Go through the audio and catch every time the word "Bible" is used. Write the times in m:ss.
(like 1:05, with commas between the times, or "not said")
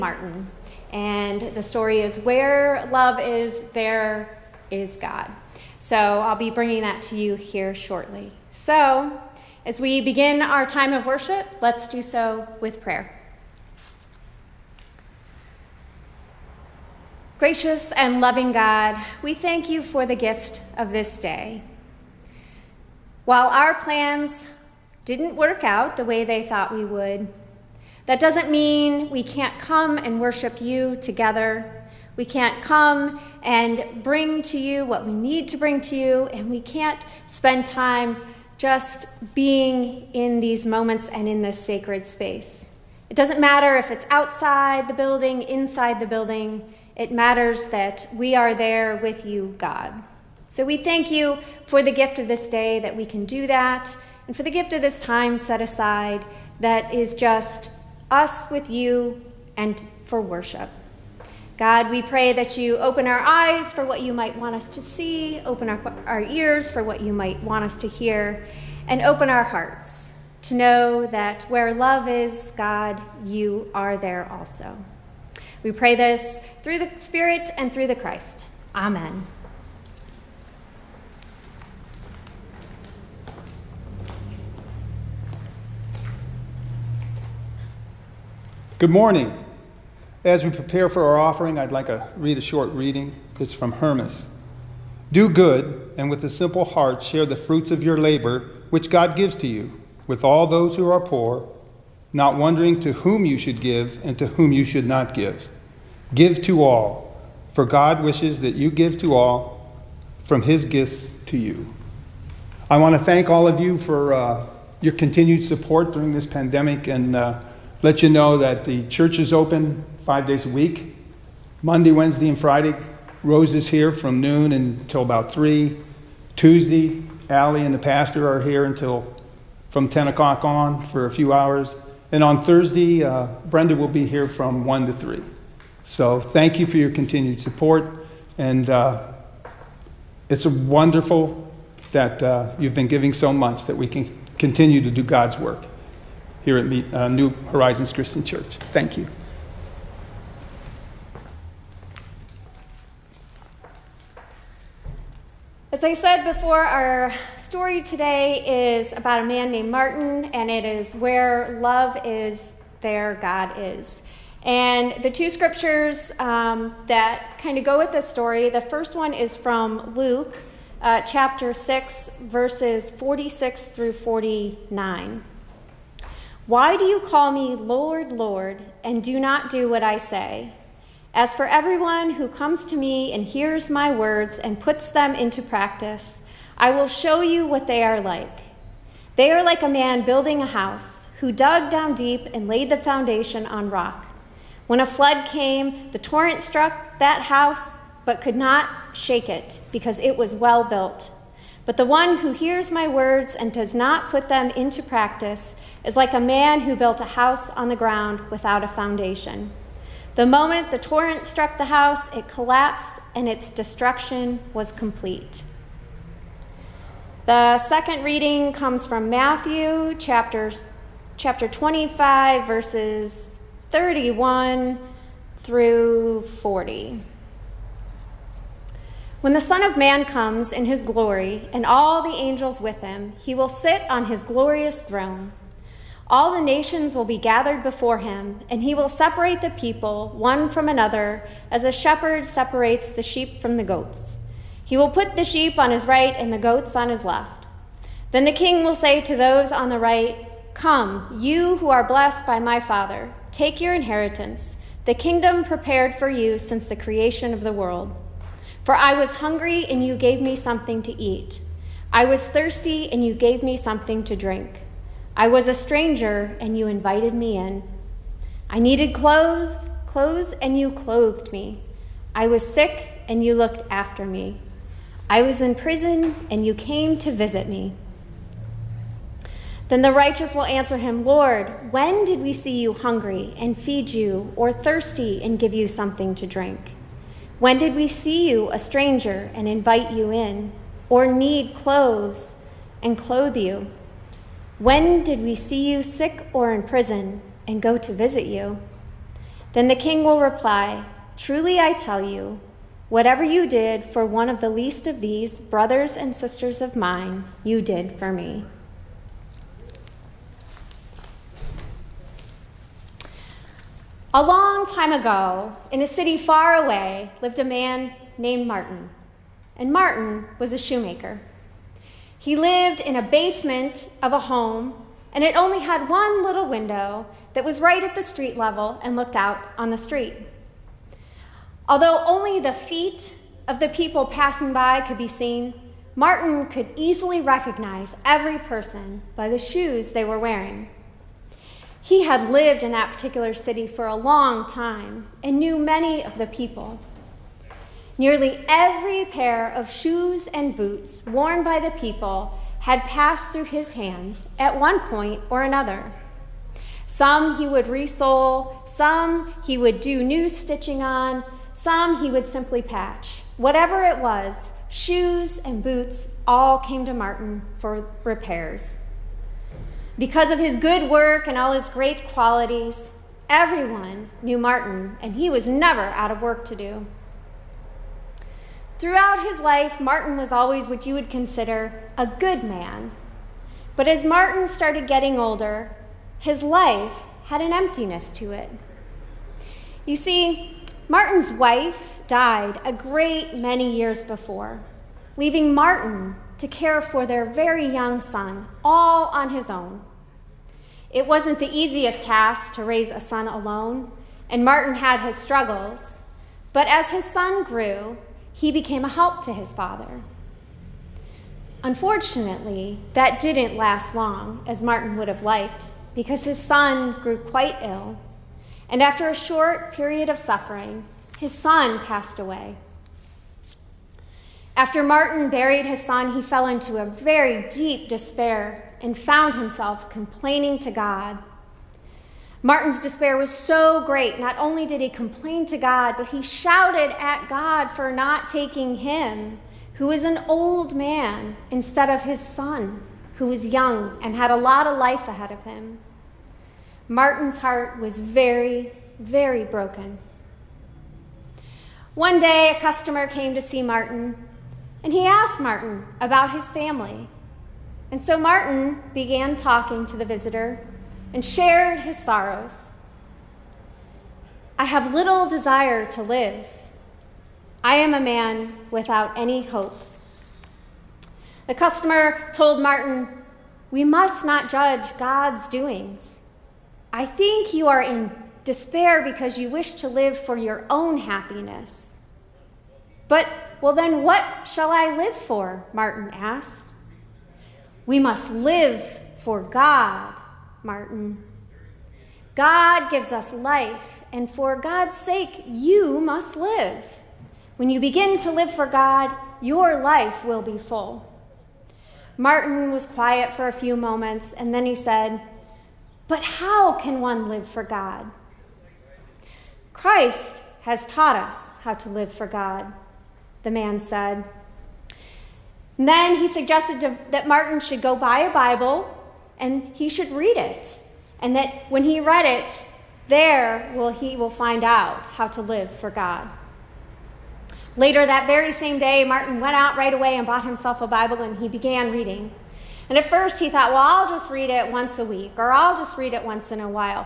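8:38, 8:50.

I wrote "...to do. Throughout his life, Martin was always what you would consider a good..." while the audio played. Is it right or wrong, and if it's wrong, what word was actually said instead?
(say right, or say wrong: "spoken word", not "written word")
right.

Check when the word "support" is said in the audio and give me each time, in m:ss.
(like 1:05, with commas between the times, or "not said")
1:55, 2:17.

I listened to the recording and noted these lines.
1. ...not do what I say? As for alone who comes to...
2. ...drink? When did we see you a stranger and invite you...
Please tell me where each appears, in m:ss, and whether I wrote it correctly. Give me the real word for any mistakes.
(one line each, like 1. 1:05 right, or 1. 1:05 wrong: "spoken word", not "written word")
1. 2:59 wrong: "everyone", not "alone"
2. 4:46 right.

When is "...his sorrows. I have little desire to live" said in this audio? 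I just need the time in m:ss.
7:41.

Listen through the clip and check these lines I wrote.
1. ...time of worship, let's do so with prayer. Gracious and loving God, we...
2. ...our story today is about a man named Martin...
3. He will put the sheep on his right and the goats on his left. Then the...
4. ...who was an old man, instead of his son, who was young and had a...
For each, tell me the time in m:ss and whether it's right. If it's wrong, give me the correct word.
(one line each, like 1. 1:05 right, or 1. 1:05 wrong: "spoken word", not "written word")
1. 0:10 right
2. 2:36 right
3. 4:04 right
4. 7:19 right.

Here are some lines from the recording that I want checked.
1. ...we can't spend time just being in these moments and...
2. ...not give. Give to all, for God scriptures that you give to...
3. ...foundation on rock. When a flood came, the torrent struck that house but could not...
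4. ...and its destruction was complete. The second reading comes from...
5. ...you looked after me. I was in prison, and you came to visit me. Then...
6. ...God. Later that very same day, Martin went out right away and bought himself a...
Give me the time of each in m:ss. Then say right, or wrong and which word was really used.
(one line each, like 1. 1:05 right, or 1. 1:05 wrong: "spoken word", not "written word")
1. 0:36 right
2. 1:44 wrong: "wishes", not "scriptures"
3. 3:12 right
4. 3:33 right
5. 4:33 right
6. 8:45 right.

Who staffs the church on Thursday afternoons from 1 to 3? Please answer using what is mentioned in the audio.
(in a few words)
Brenda.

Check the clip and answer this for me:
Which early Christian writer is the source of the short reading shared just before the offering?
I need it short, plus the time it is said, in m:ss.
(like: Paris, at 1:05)
Hermas, at 1:33.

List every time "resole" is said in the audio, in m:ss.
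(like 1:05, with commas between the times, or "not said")
5:57.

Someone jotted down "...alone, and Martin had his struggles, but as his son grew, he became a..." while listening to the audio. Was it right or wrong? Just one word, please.
right.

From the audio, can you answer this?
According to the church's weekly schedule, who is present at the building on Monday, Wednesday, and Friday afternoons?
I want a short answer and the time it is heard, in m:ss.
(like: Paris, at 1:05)
Rose, at 2:03.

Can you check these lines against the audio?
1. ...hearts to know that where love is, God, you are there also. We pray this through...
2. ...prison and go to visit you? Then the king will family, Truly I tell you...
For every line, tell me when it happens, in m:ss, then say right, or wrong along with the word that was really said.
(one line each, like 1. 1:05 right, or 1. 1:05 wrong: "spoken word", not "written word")
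1. 1:09 right
2. 4:56 wrong: "reply", not "family".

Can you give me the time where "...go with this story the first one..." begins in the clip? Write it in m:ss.
2:47.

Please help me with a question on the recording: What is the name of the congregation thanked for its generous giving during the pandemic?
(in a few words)
New Horizons Christian Church.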